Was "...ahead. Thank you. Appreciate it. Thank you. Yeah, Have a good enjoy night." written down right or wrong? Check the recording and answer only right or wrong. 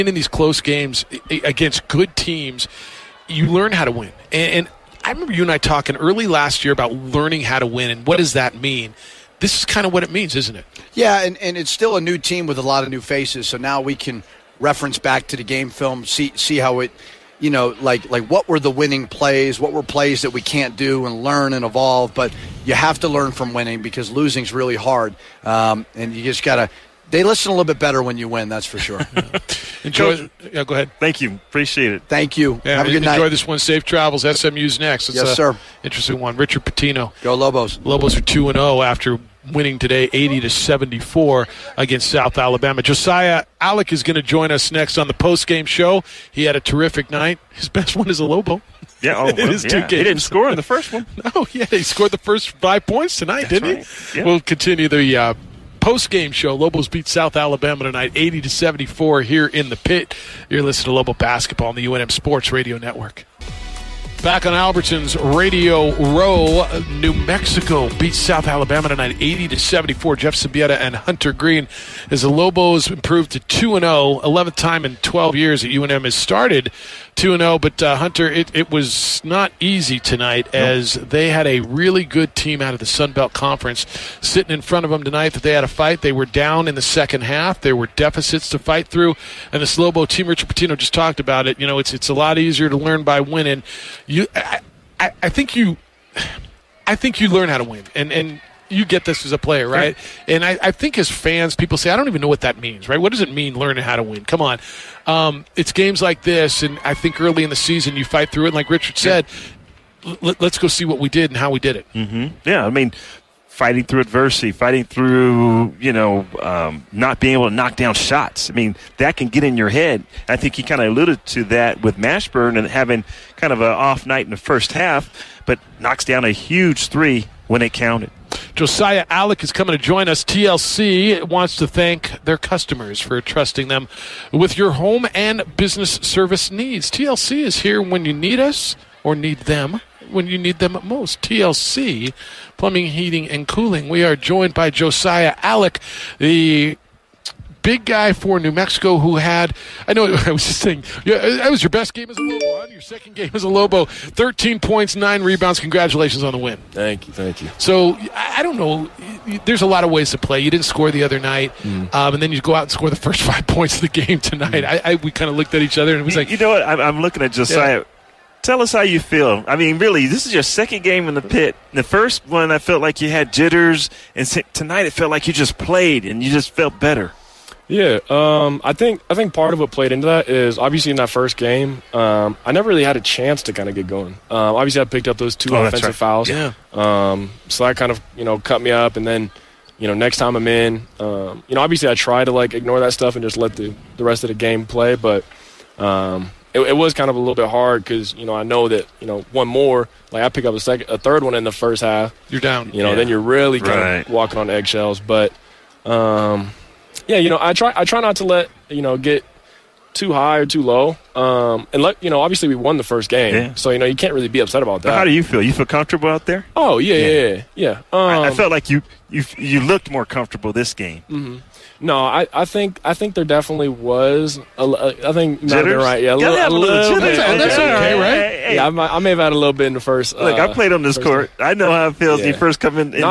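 right.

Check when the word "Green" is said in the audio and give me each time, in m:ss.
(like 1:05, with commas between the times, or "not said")
1:11.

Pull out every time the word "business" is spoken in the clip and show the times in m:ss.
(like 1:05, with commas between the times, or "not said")
2:15.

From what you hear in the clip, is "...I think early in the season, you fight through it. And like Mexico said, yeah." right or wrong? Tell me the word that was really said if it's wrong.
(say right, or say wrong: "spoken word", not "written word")
wrong: "Richard", not "Mexico".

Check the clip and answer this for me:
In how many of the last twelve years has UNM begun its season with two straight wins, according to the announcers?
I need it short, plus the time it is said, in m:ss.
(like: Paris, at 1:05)
11, at 1:14.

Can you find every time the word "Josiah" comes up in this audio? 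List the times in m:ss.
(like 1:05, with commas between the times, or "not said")
0:42, 2:08, 2:24, 2:47.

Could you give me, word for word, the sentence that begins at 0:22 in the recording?
But you have to learn from winning because losing's really hard, um, and you just gotta.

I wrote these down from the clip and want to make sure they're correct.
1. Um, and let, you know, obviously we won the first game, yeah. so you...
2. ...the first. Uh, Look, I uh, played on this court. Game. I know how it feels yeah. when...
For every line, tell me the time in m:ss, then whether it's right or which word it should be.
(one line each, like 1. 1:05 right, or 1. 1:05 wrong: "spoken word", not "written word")
1. 3:31 right
2. 3:49 right.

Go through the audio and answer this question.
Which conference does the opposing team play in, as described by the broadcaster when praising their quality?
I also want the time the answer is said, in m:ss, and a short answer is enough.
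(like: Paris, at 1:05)
Sun Belt Conference, at 1:22.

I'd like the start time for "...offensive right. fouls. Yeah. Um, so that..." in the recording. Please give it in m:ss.
3:05.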